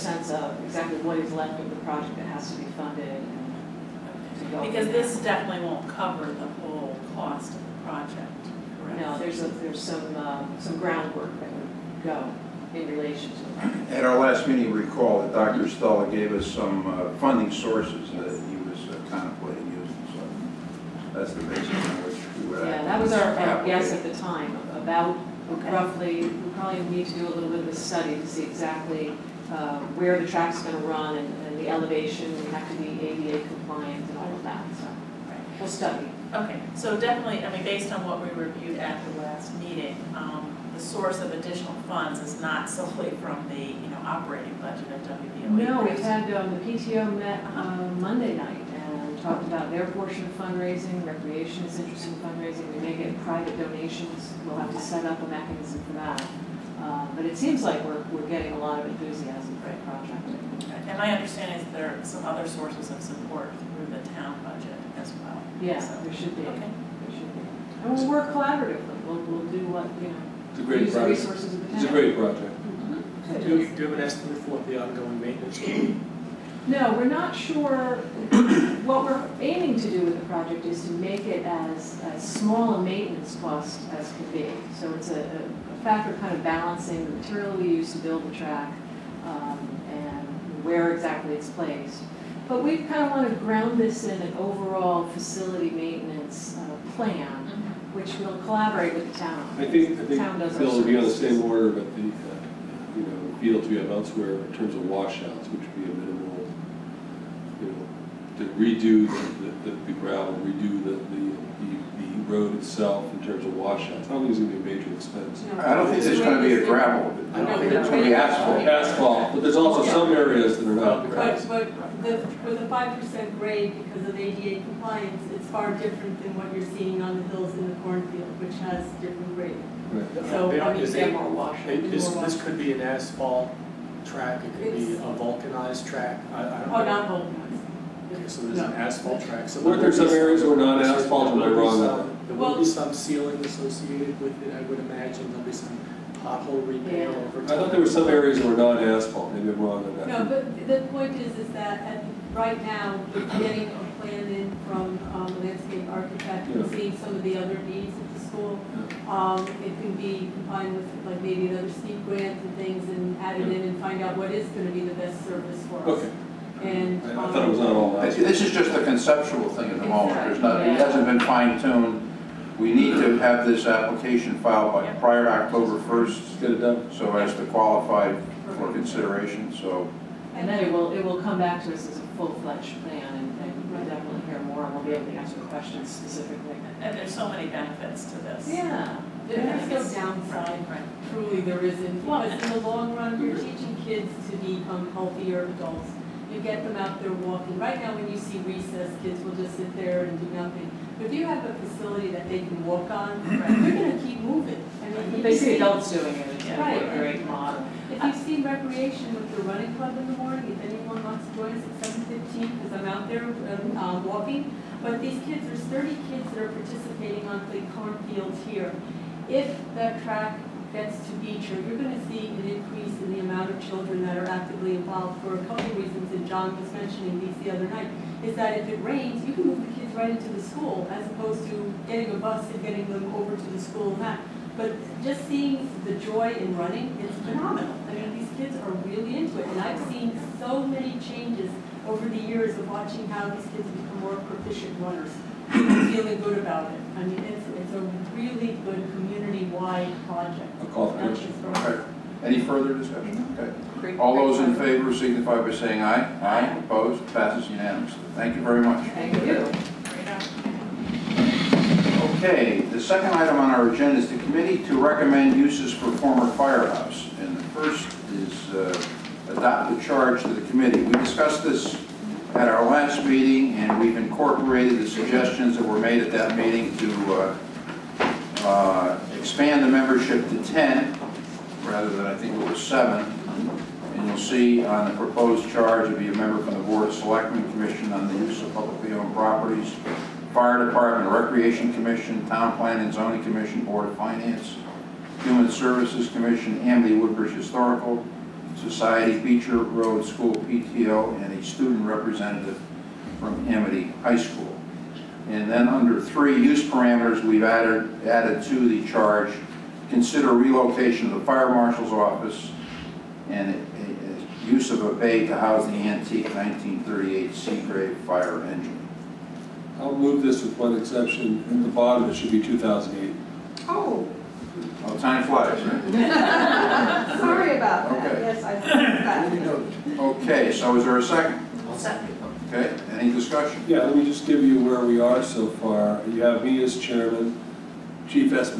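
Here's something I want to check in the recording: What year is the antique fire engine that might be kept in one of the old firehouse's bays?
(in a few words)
1938.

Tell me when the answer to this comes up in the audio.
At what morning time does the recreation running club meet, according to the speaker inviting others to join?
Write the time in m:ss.
3:32.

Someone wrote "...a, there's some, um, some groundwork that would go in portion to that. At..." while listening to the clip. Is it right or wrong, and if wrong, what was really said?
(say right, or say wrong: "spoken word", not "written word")
wrong: "relation", not "portion".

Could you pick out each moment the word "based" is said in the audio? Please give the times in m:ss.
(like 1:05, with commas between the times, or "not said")
0:37.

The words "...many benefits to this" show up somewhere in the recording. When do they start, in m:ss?
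3:07.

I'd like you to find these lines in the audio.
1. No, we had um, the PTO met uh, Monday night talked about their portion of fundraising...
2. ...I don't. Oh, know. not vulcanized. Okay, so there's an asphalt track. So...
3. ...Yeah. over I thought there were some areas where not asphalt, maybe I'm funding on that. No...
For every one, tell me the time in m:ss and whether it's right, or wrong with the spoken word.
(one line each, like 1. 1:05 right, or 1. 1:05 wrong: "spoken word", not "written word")
1. 0:45 right
2. 2:16 right
3. 2:27 wrong: "wrong", not "funding".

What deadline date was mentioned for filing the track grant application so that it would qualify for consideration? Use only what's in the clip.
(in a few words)
October 1.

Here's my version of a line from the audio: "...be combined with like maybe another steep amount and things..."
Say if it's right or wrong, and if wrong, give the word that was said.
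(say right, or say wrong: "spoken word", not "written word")
wrong: "grant", not "amount".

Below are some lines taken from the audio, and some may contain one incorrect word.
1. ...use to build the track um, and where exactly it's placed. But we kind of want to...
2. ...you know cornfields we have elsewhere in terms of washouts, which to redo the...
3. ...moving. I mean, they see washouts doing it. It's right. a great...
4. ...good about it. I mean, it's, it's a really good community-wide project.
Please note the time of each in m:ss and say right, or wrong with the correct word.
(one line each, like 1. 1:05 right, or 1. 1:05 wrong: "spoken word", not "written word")
1. 1:27 right
2. 1:42 wrong: "fields", not "cornfields"
3. 3:24 wrong: "adults", not "washouts"
4. 4:06 right.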